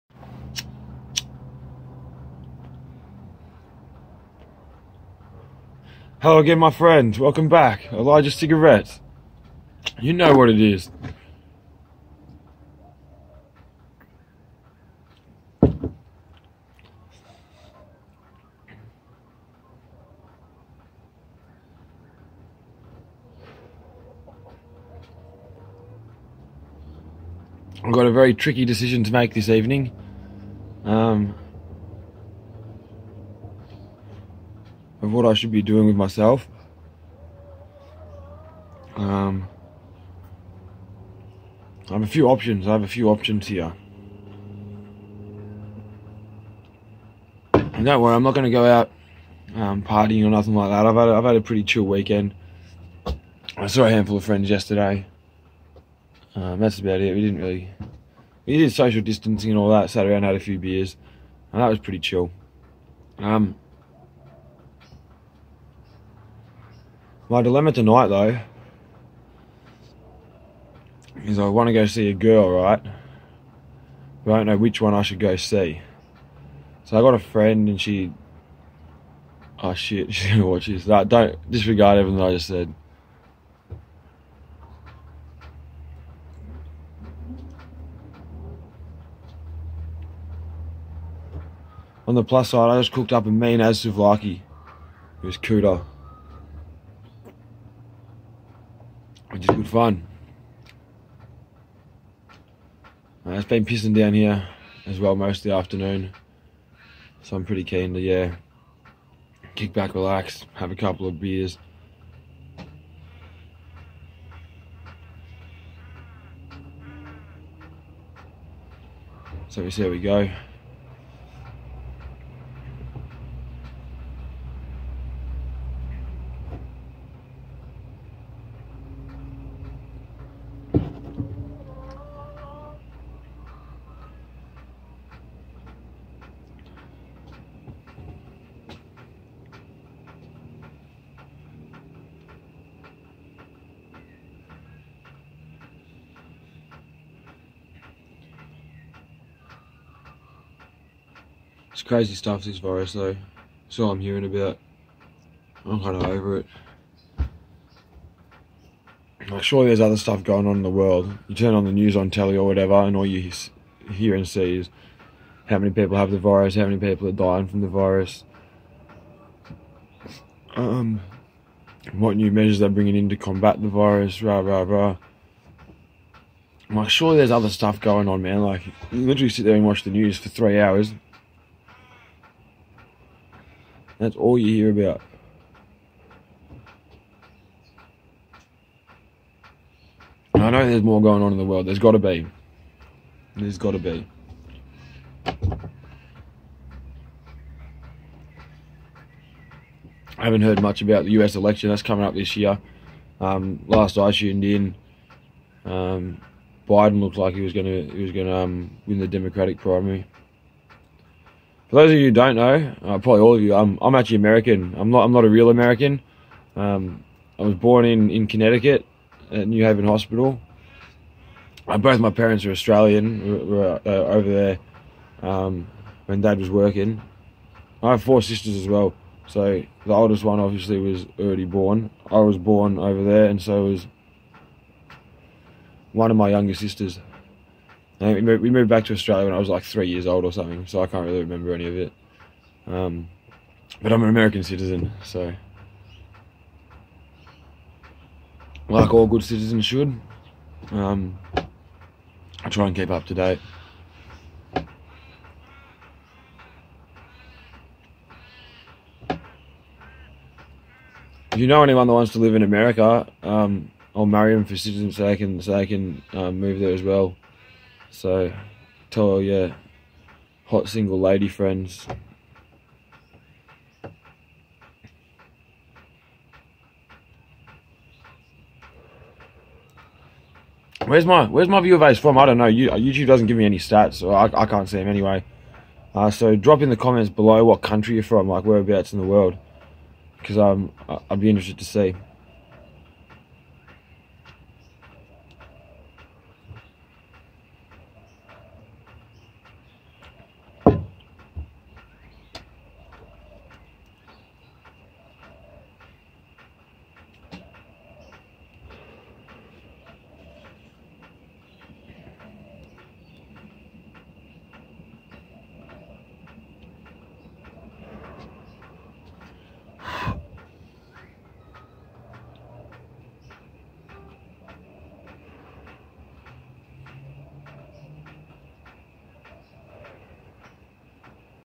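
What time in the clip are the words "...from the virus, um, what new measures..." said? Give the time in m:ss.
2:47.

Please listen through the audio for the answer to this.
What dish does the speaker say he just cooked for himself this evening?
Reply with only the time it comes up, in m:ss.
1:33.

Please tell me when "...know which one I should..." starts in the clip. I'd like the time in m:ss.
1:14.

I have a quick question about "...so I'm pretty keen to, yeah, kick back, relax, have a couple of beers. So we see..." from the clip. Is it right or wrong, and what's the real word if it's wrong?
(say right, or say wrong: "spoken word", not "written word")
right.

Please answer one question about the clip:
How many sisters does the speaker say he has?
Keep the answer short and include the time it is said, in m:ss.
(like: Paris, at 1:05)
4, at 3:48.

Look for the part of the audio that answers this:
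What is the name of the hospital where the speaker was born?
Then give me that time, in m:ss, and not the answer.
3:39.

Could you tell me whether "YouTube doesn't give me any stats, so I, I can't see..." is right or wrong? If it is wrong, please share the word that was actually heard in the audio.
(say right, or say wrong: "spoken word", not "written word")
right.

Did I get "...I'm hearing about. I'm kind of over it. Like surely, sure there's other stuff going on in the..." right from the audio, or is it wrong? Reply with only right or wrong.
right.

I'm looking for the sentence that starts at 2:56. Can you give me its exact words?
I'm like, sure there's other stuff going on, man.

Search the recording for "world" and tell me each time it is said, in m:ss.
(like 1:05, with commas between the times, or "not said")
2:40, 3:11, 4:49.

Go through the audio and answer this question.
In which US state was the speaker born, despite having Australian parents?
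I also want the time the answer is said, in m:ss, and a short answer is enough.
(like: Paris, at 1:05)
Connecticut, at 3:38.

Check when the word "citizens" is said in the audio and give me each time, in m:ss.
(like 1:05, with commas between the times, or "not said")
4:04, 4:09, 4:24.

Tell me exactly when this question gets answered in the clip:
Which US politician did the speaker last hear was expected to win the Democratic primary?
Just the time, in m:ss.
3:26.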